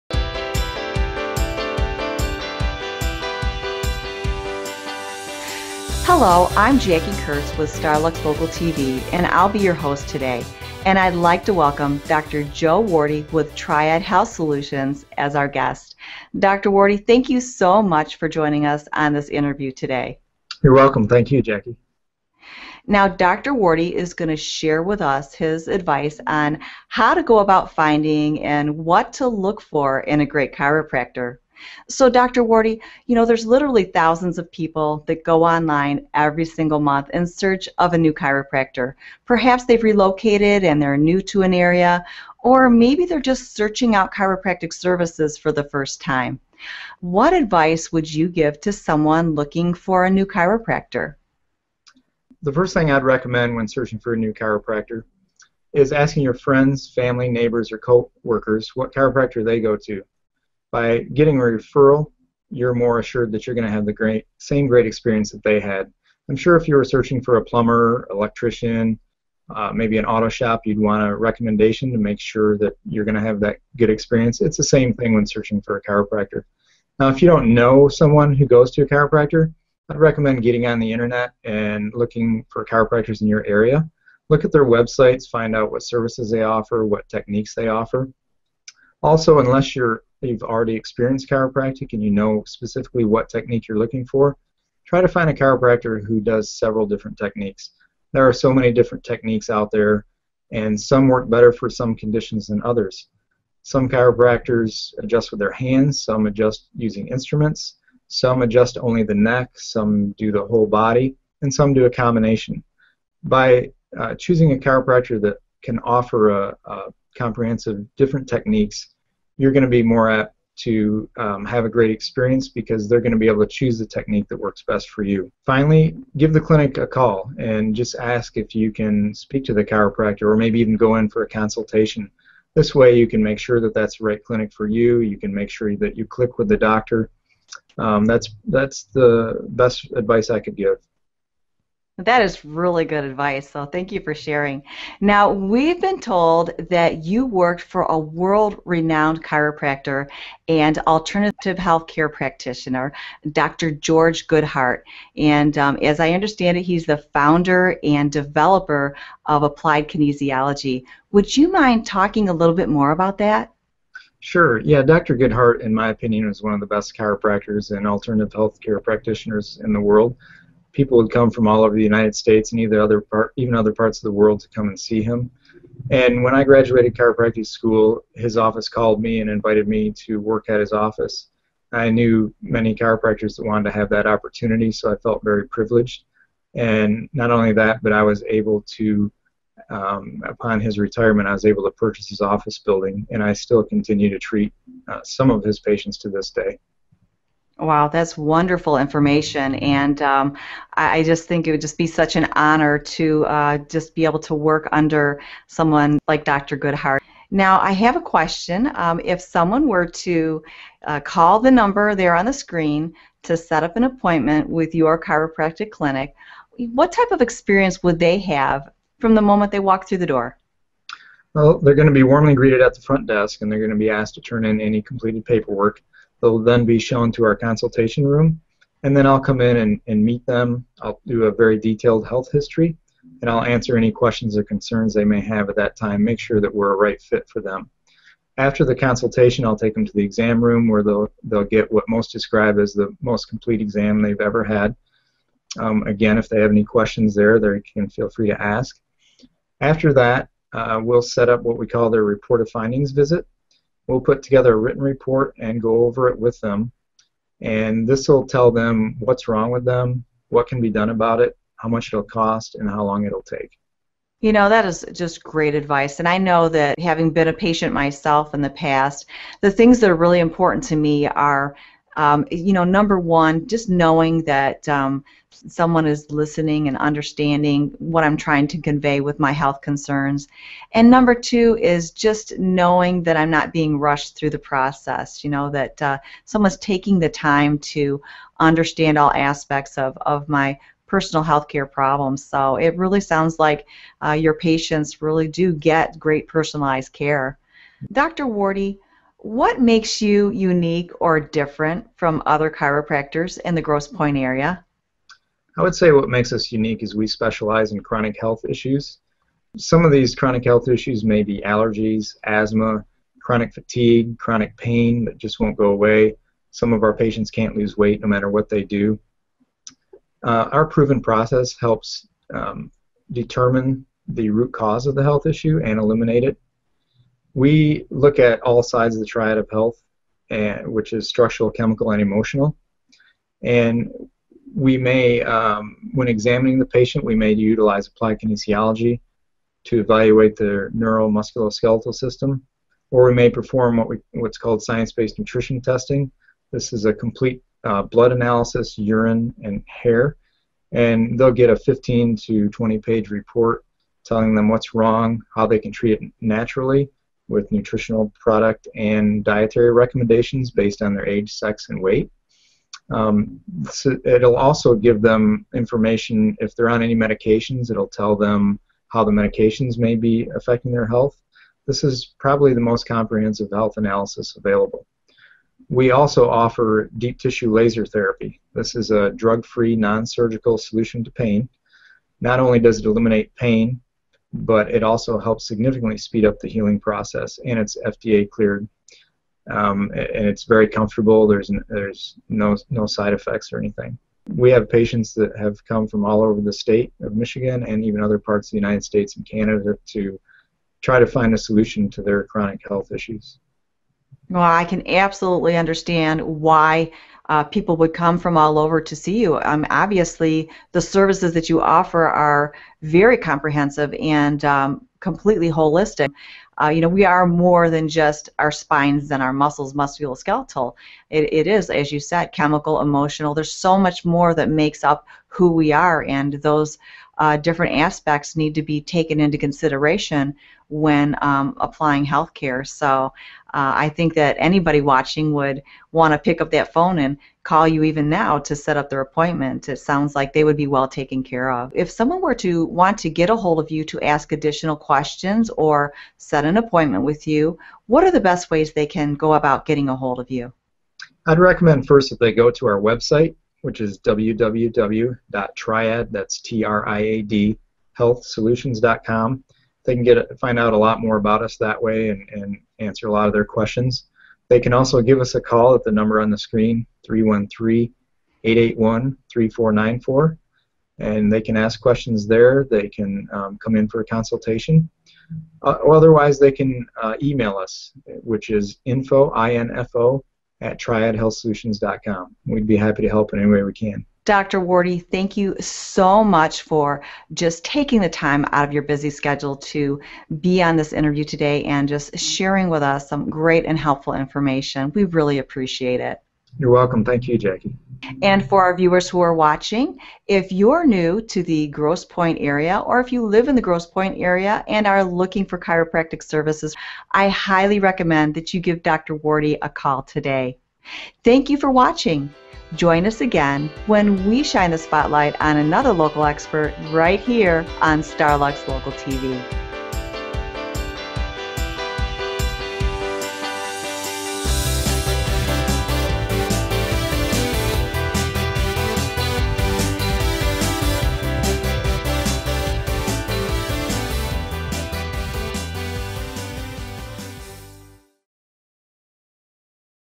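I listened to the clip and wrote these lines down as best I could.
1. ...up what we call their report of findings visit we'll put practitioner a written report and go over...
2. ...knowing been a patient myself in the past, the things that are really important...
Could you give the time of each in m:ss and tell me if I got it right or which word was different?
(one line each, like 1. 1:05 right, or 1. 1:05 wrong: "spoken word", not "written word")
1. 4:11 wrong: "together", not "practitioner"
2. 4:26 wrong: "having", not "knowing".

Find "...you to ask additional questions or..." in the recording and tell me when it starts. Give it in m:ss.
7:23.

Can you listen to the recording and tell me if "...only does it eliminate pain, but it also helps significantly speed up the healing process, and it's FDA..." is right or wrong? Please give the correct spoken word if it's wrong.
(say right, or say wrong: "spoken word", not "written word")
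right.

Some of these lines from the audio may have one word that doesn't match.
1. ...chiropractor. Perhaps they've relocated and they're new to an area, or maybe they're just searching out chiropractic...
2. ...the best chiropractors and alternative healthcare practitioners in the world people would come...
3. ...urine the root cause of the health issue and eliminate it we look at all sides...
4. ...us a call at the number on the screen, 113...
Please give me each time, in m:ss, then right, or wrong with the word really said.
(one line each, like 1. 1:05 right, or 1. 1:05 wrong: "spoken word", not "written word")
1. 0:38 right
2. 2:46 right
3. 5:23 wrong: "determine", not "urine"
4. 7:45 wrong: "313", not "113".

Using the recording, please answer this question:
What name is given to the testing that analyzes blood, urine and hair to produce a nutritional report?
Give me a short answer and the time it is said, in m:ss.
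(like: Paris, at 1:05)
science-based nutrition testing, at 5:44.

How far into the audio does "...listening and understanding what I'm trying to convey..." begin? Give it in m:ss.
4:36.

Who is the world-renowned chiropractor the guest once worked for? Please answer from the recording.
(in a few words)
Dr. George Goodheart.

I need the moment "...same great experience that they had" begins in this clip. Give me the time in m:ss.
1:04.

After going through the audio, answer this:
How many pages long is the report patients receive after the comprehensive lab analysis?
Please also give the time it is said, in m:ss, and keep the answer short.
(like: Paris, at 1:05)
15 to 20, at 5:51.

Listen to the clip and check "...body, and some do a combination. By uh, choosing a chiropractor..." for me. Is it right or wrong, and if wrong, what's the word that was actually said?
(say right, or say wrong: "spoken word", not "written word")
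right.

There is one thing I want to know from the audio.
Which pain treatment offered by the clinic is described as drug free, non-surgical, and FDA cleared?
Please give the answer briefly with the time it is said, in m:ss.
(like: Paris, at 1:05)
deep tissue laser therapy, at 6:16.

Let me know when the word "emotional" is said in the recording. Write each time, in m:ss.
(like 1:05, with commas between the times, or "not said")
5:32, 7:02.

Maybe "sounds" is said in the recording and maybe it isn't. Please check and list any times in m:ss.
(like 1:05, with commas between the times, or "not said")
4:53, 7:19.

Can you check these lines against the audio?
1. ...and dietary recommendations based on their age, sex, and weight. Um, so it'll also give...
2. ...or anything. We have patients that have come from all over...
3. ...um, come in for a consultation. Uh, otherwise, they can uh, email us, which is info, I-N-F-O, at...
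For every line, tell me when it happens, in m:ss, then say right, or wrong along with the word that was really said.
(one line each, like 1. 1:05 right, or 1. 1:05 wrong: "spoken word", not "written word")
1. 5:58 right
2. 6:33 right
3. 7:53 right.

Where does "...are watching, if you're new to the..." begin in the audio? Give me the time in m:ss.
8:19.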